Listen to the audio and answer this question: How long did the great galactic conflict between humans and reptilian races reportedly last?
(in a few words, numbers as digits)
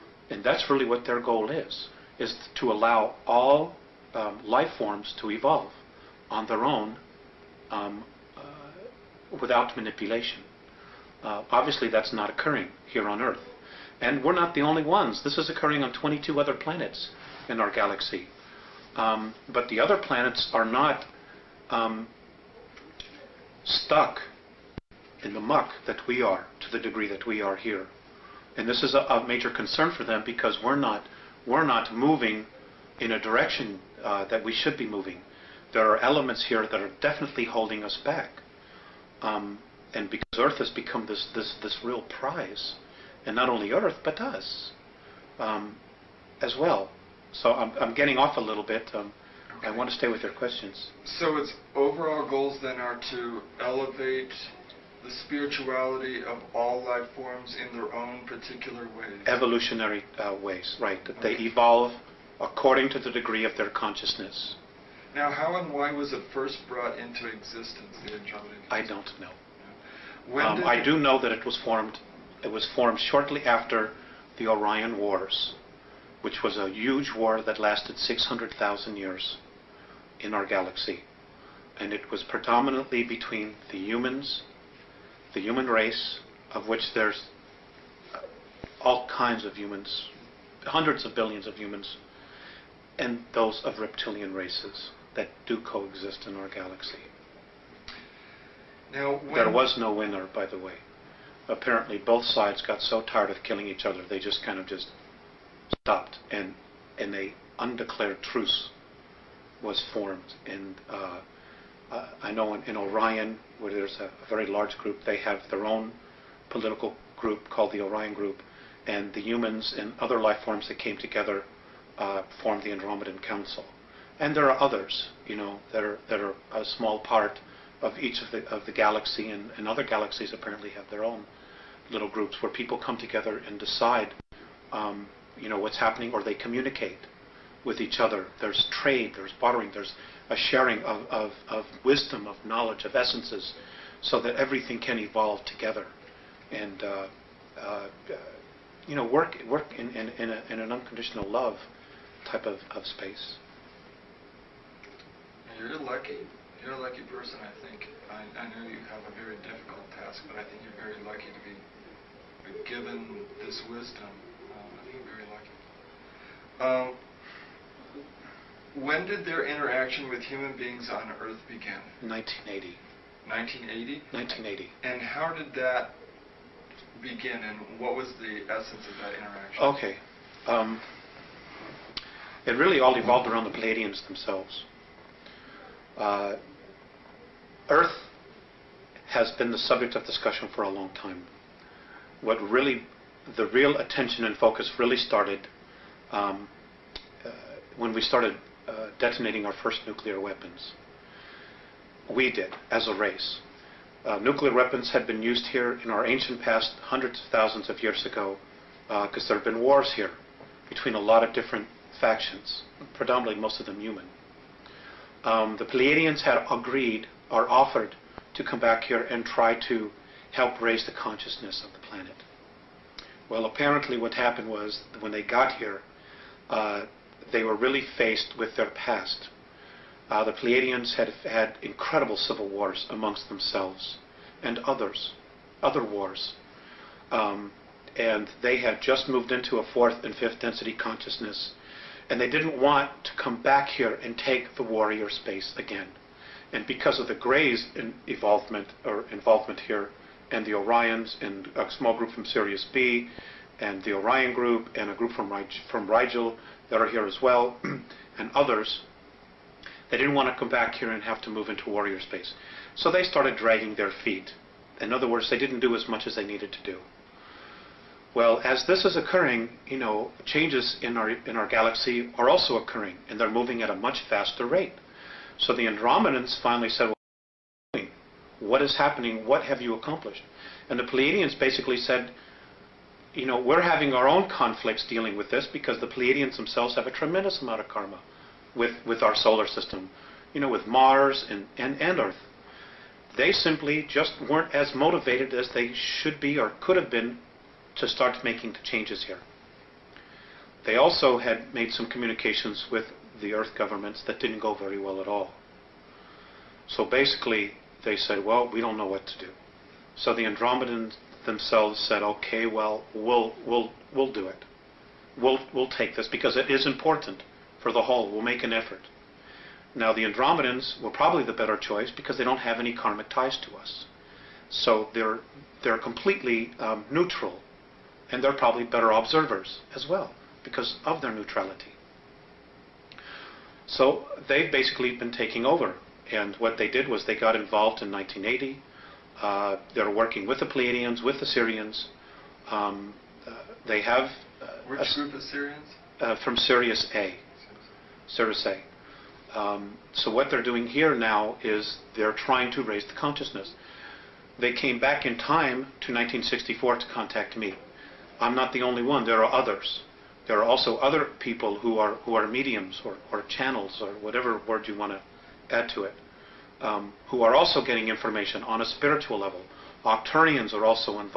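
600,000 years.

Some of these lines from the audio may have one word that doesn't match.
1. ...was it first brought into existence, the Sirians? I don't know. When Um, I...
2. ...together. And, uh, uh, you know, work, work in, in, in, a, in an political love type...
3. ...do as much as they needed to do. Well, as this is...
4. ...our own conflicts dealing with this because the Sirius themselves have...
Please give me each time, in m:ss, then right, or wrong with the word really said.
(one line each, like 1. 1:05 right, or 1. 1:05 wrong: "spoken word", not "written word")
1. 1:05 wrong: "Andromeda", not "Sirians"
2. 2:25 wrong: "unconditional", not "political"
3. 4:25 right
4. 4:43 wrong: "Pleiadians", not "Sirius".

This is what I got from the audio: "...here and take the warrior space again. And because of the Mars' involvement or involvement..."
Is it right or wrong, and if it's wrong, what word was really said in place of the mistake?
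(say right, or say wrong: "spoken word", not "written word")
wrong: "Greys", not "Mars".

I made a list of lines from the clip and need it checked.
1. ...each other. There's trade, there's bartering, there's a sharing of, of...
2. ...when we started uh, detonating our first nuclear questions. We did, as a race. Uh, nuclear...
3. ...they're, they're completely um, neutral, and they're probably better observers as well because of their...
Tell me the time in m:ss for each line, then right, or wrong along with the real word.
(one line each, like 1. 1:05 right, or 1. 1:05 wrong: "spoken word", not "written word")
1. 2:17 right
2. 3:17 wrong: "weapons", not "questions"
3. 5:24 right.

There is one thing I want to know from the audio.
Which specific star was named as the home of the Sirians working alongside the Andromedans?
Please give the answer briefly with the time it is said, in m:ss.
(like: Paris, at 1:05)
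Sirius A, at 5:46.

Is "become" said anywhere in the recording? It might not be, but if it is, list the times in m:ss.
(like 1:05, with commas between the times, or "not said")
0:40.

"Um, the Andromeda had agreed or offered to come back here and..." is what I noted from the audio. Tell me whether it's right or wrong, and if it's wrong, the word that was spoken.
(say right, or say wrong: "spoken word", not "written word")
wrong: "Pleiadians", not "Andromeda".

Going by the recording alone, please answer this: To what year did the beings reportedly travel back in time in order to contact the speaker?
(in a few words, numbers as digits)
1964.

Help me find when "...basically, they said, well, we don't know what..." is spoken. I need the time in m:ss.
5:06.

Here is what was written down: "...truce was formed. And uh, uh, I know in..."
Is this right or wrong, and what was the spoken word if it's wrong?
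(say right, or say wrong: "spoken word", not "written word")
right.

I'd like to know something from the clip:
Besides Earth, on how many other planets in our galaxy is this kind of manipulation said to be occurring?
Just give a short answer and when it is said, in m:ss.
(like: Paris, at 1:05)
22, at 0:15.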